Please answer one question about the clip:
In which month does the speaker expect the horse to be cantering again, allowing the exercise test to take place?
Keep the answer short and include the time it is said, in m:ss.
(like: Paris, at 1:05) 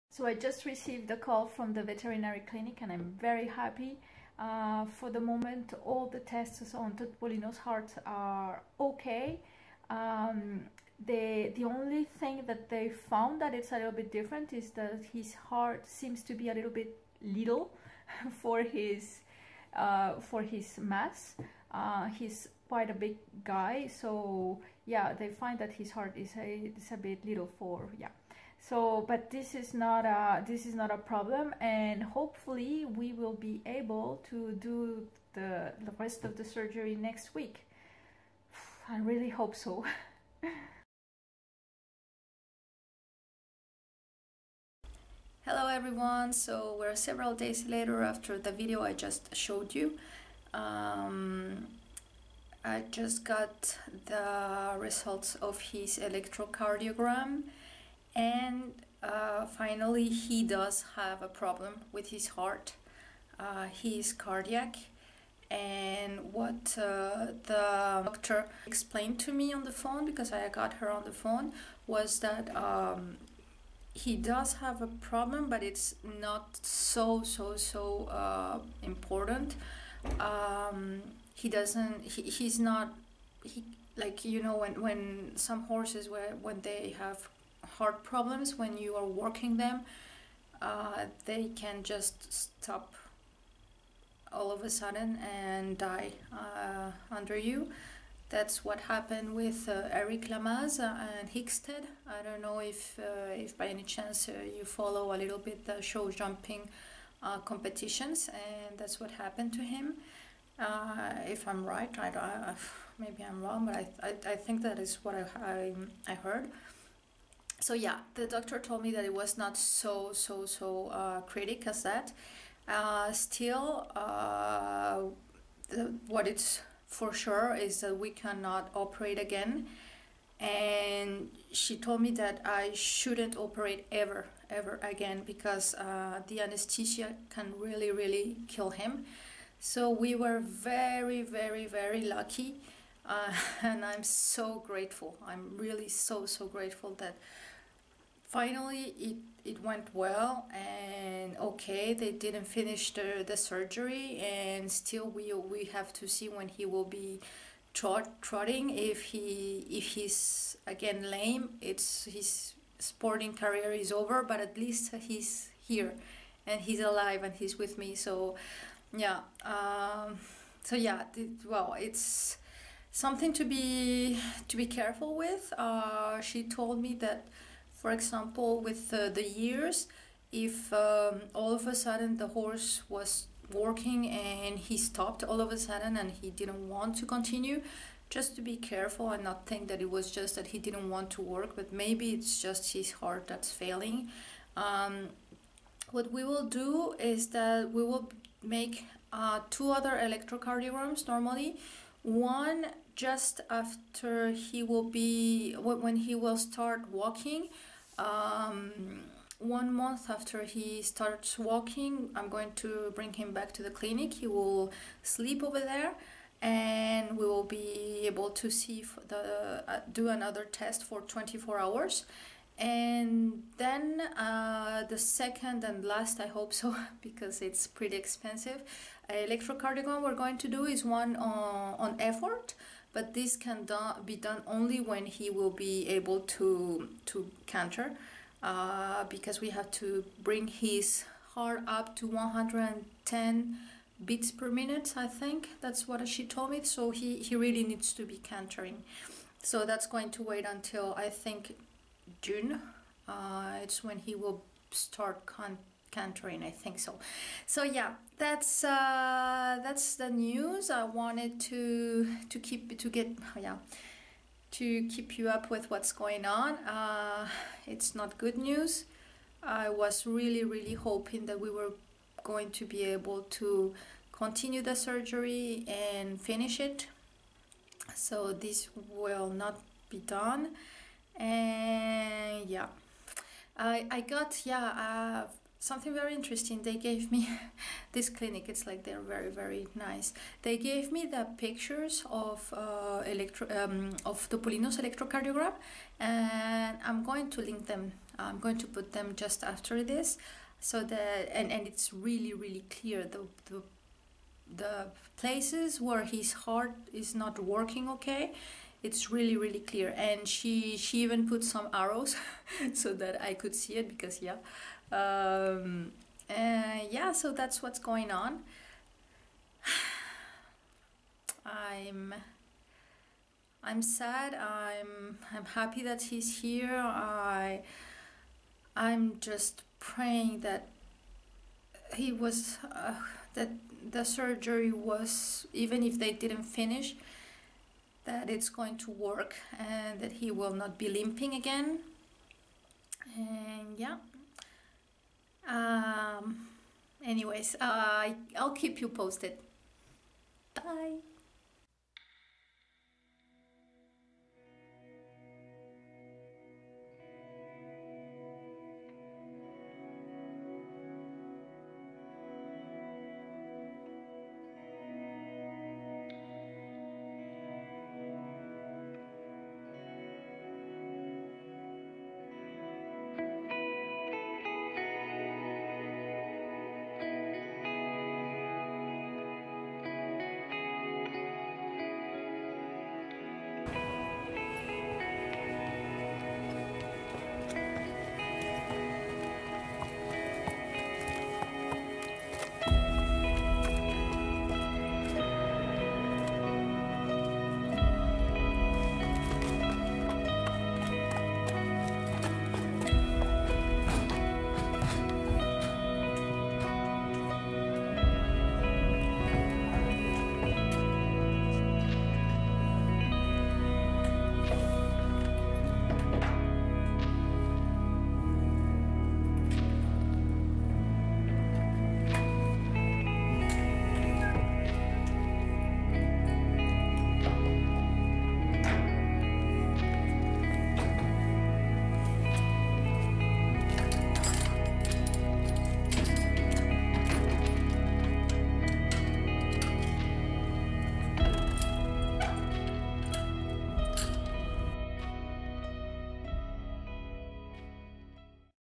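June, at 4:12.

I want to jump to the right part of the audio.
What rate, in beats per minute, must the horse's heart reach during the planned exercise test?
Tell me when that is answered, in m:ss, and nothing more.
4:02.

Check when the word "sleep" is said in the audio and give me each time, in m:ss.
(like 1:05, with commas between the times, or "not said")
3:35.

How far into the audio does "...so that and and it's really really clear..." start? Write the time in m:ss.
5:00.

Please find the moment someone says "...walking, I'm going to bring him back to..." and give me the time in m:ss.
3:31.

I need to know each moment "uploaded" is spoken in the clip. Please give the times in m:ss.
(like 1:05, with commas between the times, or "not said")
not said.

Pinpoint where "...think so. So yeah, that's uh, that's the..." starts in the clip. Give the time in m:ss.
4:16.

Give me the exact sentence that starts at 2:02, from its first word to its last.
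Uh, still, uh, the, what it's for sure is that we cannot operate again.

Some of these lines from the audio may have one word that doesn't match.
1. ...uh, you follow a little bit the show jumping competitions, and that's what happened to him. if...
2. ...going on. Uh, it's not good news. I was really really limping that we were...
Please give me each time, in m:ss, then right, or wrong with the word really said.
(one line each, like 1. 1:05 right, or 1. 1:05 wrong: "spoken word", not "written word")
1. 1:44 right
2. 4:25 wrong: "hoping", not "limping".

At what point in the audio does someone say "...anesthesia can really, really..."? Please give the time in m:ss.
2:16.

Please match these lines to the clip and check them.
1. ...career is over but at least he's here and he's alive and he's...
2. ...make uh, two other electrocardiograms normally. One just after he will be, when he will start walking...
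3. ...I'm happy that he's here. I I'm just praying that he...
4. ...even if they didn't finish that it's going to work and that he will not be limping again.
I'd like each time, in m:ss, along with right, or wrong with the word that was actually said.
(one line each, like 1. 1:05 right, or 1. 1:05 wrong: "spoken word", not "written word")
1. 2:43 right
2. 3:18 right
3. 5:25 right
4. 5:35 right.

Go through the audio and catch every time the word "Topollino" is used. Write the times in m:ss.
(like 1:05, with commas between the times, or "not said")
0:06, 4:54.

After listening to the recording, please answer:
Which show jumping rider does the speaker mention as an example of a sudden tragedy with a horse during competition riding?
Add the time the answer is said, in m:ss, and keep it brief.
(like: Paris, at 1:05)
Eric Lamaze, at 1:39.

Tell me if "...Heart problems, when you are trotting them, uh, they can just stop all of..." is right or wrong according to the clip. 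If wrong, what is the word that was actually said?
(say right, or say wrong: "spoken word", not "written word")
wrong: "working", not "trotting".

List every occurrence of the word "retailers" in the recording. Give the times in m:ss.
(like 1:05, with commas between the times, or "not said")
not said.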